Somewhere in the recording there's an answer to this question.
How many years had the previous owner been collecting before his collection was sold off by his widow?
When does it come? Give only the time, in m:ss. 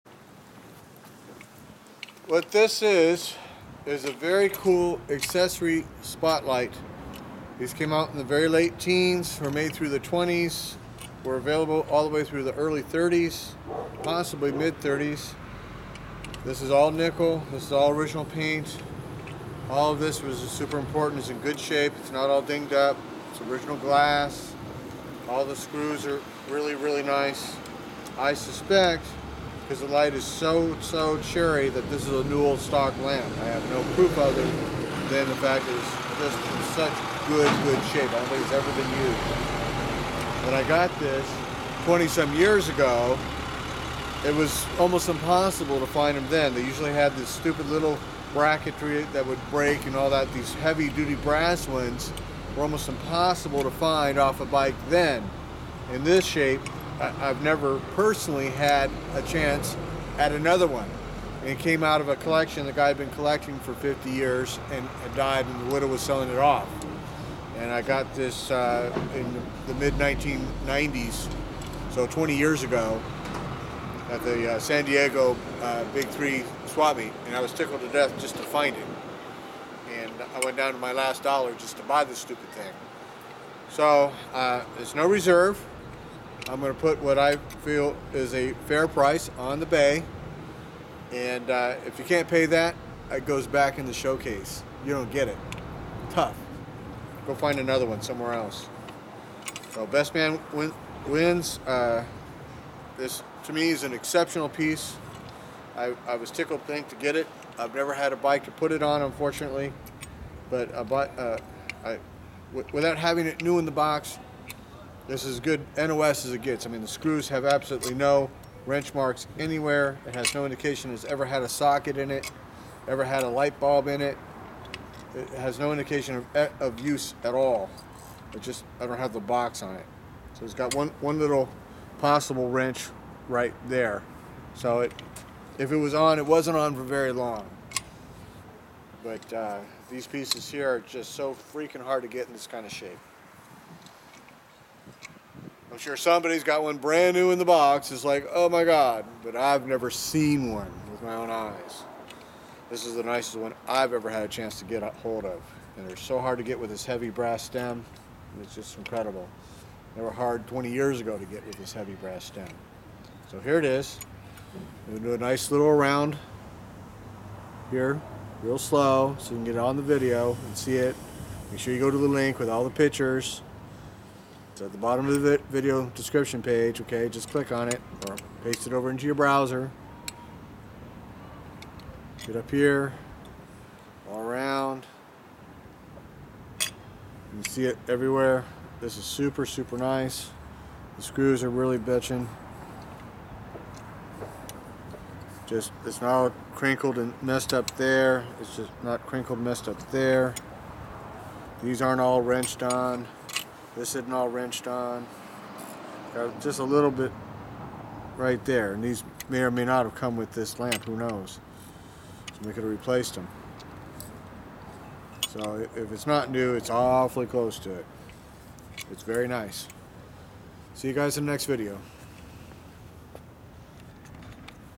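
1:03.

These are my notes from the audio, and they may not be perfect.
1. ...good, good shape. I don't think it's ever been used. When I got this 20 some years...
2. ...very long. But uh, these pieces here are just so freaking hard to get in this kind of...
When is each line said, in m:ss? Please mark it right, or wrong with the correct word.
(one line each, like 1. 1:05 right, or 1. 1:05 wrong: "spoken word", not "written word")
1. 0:37 right
2. 2:16 right.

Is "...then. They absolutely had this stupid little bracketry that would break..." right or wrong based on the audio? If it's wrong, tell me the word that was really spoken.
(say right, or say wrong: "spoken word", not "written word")
wrong: "usually", not "absolutely".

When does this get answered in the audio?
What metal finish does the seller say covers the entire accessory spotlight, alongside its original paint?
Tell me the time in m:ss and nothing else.
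0:16.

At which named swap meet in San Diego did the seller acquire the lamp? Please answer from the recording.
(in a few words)
Big Three Swap Meet.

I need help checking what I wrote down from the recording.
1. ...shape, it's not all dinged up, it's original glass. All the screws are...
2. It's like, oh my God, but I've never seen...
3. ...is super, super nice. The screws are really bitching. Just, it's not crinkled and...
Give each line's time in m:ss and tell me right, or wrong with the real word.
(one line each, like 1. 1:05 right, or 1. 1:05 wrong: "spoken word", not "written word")
1. 0:21 right
2. 2:27 right
3. 3:08 right.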